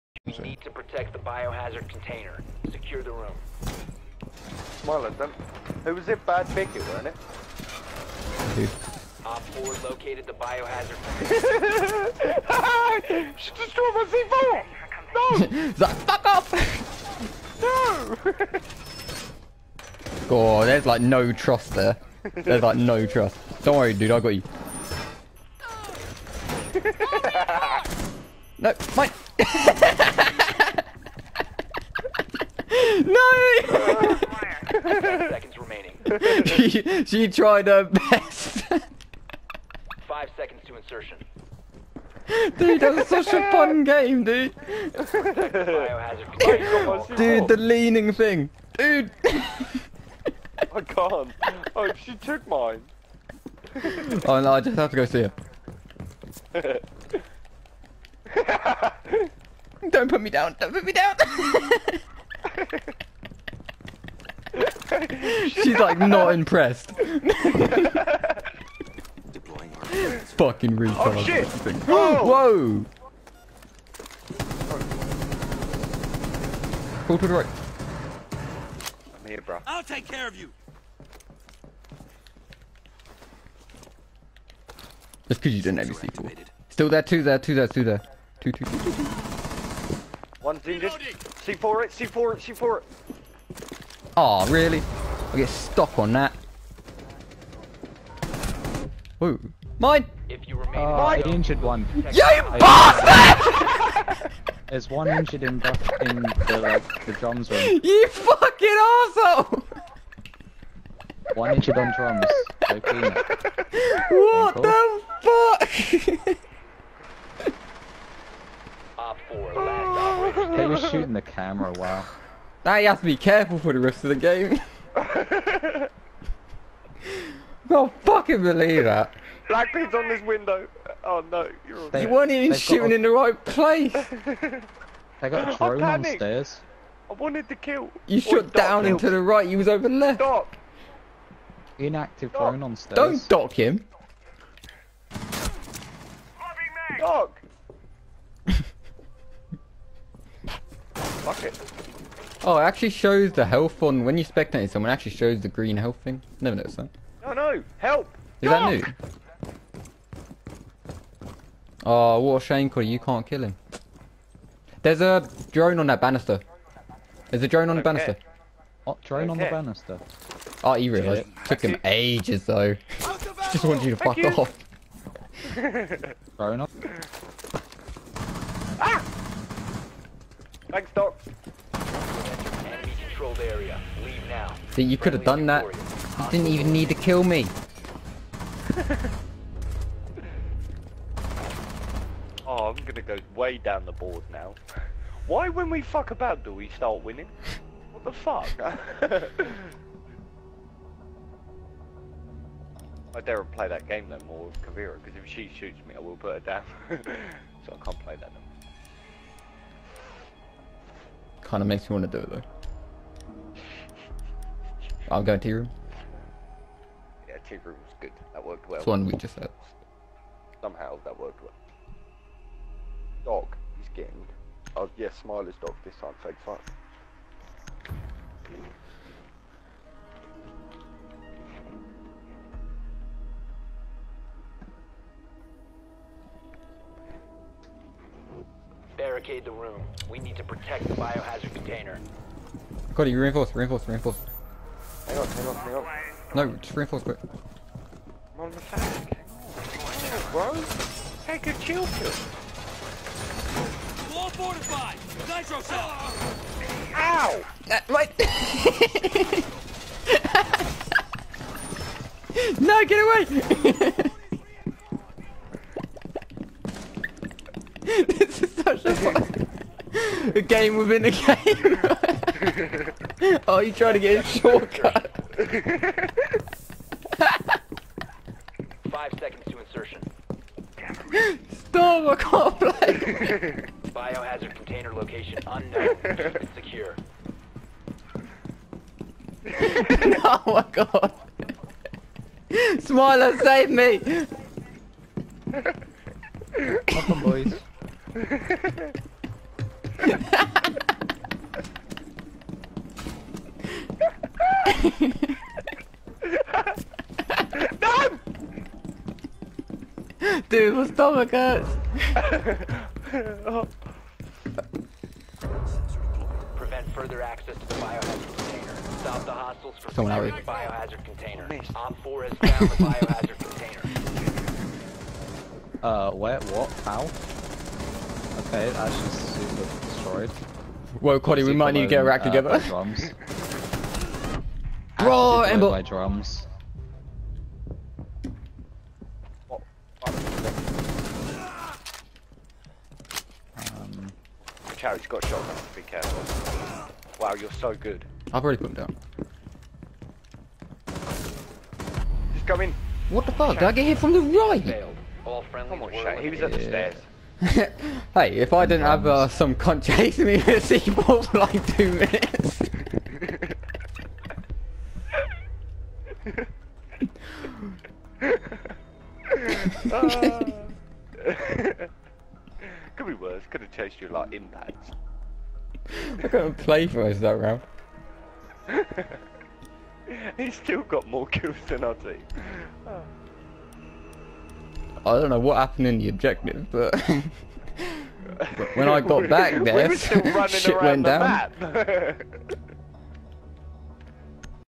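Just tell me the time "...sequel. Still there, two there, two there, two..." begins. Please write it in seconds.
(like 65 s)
85 s.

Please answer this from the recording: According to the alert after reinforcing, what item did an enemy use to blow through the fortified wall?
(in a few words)
Nitro cell.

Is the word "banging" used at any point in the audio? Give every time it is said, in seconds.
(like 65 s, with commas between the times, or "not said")
not said.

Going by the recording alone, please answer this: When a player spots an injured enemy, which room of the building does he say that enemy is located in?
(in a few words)
Drums room.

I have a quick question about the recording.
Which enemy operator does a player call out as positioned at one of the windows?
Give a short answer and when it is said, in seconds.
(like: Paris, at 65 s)
Blackbeard, at 129 s.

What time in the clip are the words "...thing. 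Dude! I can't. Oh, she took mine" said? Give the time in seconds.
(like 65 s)
48 s.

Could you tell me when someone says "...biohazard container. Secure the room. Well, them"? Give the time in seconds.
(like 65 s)
1 s.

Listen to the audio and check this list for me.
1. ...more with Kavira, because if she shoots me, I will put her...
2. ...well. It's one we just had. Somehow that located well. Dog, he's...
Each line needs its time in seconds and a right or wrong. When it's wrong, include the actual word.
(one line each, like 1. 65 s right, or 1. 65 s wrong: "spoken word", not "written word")
1. 204 s right
2. 218 s wrong: "worked", not "located".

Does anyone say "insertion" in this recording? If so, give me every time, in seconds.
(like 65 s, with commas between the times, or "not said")
40 s, 279 s.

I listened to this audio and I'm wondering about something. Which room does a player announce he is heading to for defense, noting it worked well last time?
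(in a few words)
T room.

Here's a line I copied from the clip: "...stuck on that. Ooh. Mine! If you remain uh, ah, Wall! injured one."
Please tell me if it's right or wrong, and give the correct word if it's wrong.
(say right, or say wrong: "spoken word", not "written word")
wrong: "Mine", not "Wall".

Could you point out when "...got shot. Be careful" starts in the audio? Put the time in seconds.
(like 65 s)
345 s.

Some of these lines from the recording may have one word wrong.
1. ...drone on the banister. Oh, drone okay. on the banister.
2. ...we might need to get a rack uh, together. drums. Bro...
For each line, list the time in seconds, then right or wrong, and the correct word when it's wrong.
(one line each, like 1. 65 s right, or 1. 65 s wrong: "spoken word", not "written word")
1. 167 s right
2. 331 s right.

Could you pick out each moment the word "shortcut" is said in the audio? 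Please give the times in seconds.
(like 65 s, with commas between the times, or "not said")
274 s.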